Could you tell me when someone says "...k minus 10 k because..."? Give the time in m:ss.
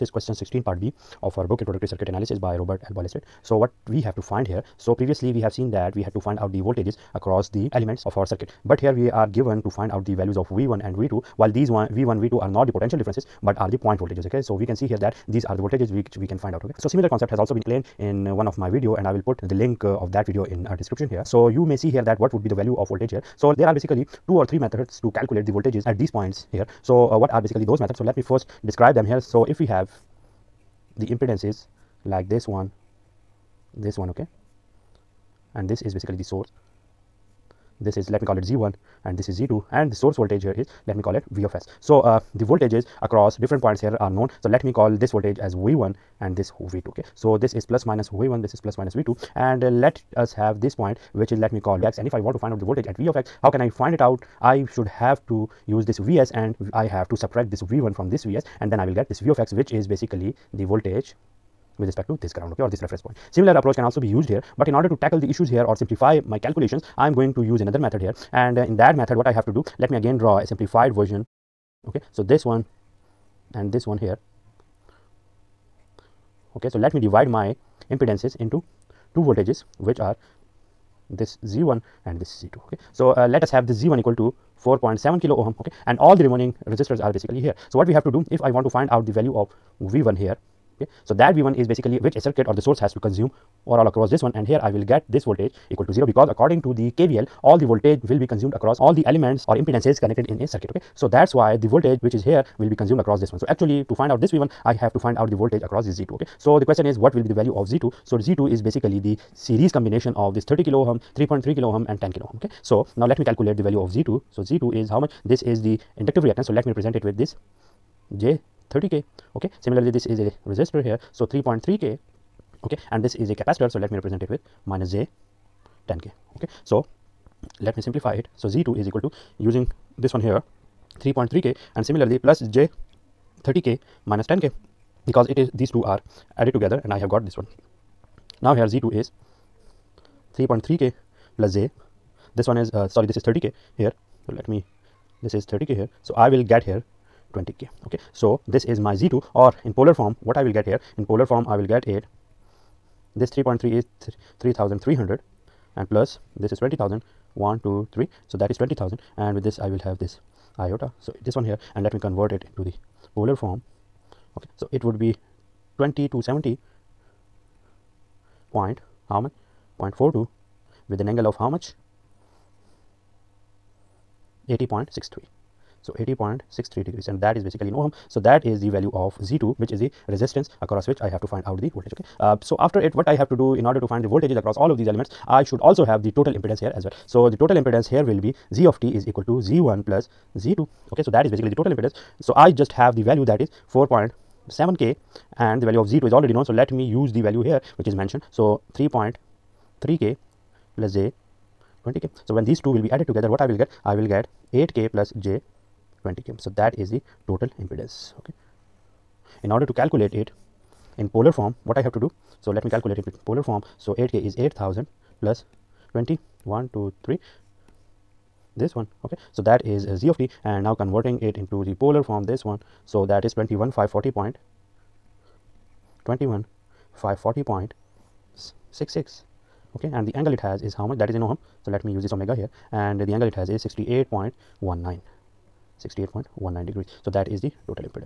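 2:13.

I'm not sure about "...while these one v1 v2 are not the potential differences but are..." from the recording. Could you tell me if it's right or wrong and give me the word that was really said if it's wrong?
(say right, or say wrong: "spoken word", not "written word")
right.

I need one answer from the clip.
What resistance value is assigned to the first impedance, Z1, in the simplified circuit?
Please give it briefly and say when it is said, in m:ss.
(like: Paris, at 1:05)
4.7 kilo ohm, at 1:24.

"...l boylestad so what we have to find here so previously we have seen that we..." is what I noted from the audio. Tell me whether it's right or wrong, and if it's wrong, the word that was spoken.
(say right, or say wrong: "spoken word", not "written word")
right.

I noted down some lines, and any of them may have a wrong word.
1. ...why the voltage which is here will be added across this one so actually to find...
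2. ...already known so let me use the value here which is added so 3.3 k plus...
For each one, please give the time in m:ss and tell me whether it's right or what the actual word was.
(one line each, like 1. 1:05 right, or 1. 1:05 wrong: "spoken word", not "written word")
1. 1:41 wrong: "consumed", not "added"
2. 3:16 wrong: "mentioned", not "added".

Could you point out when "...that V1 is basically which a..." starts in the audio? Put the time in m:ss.
1:31.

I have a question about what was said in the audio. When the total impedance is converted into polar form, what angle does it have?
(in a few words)
68.19 degrees.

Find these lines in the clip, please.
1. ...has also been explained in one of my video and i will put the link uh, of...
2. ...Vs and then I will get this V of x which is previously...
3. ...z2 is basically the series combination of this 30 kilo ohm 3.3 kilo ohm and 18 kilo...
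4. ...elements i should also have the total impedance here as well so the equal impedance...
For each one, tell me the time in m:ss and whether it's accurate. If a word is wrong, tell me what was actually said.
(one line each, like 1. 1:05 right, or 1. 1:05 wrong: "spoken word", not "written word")
1. 0:17 right
2. 0:58 wrong: "basically", not "previously"
3. 1:48 wrong: "10", not "18"
4. 3:04 wrong: "total", not "equal".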